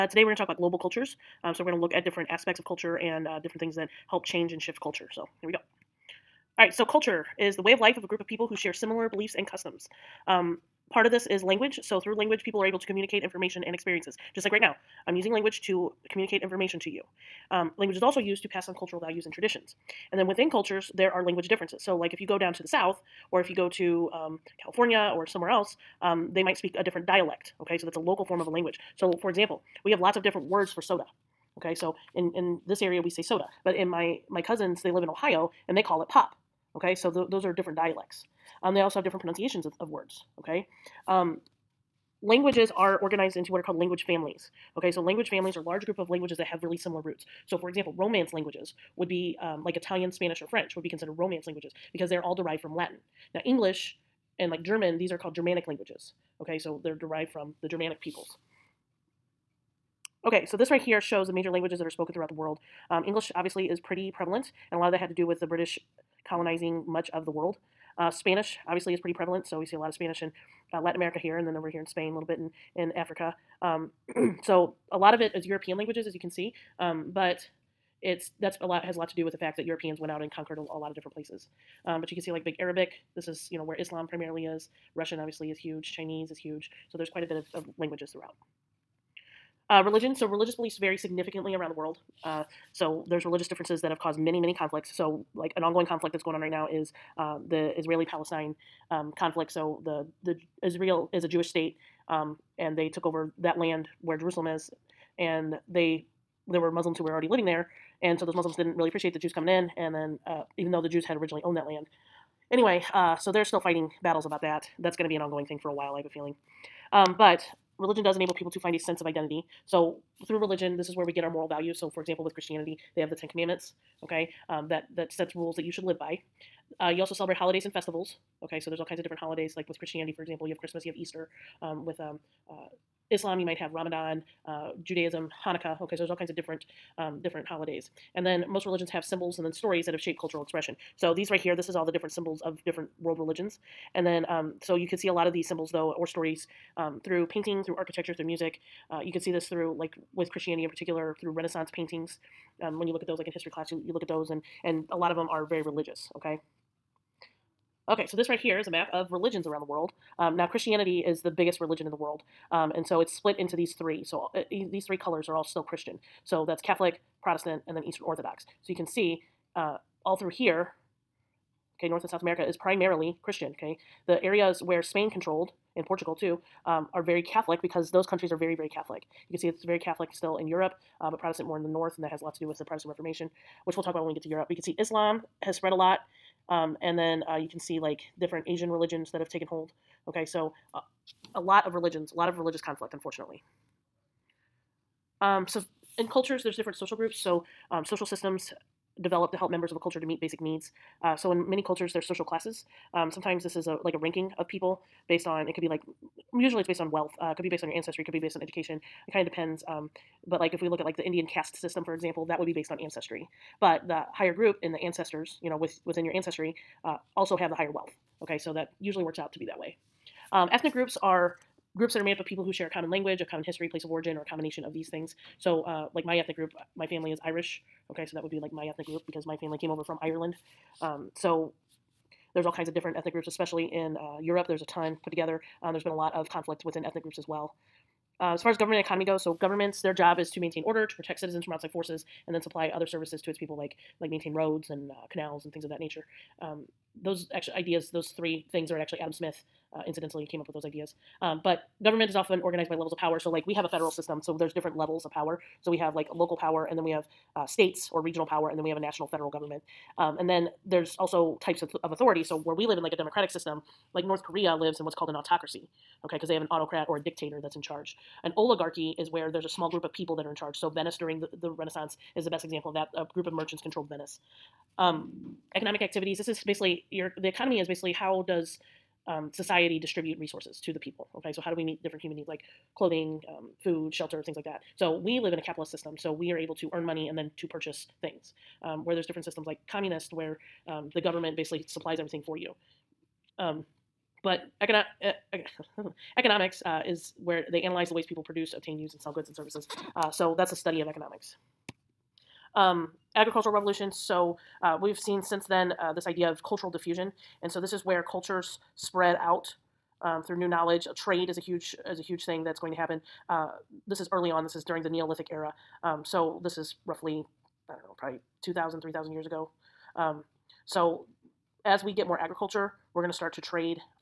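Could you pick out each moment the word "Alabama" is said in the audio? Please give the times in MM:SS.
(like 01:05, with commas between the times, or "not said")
not said.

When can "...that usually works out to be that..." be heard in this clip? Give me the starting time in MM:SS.
03:38.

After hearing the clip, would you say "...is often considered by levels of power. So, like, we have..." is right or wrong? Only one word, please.
wrong.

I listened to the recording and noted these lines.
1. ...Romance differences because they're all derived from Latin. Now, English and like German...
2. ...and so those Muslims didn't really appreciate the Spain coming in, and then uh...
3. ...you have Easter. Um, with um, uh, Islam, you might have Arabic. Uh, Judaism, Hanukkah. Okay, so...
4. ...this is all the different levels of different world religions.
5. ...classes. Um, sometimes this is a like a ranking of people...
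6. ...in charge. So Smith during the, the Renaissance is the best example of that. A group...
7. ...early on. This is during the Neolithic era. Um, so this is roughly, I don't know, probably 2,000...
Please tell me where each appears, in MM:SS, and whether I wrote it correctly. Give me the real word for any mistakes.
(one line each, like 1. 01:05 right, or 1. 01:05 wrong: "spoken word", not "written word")
1. 00:51 wrong: "languages", not "differences"
2. 01:48 wrong: "Jews", not "Spain"
3. 02:10 wrong: "Ramadan", not "Arabic"
4. 02:21 wrong: "symbols", not "levels"
5. 03:22 right
6. 04:30 wrong: "Venice", not "Smith"
7. 05:14 right.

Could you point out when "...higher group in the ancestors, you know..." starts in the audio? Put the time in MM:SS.
03:34.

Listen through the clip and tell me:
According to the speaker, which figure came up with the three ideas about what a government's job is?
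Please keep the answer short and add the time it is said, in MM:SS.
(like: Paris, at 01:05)
Adam Smith, at 04:08.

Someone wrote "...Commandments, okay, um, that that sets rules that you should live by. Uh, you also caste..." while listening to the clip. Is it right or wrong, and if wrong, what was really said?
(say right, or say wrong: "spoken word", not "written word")
wrong: "celebrate", not "caste".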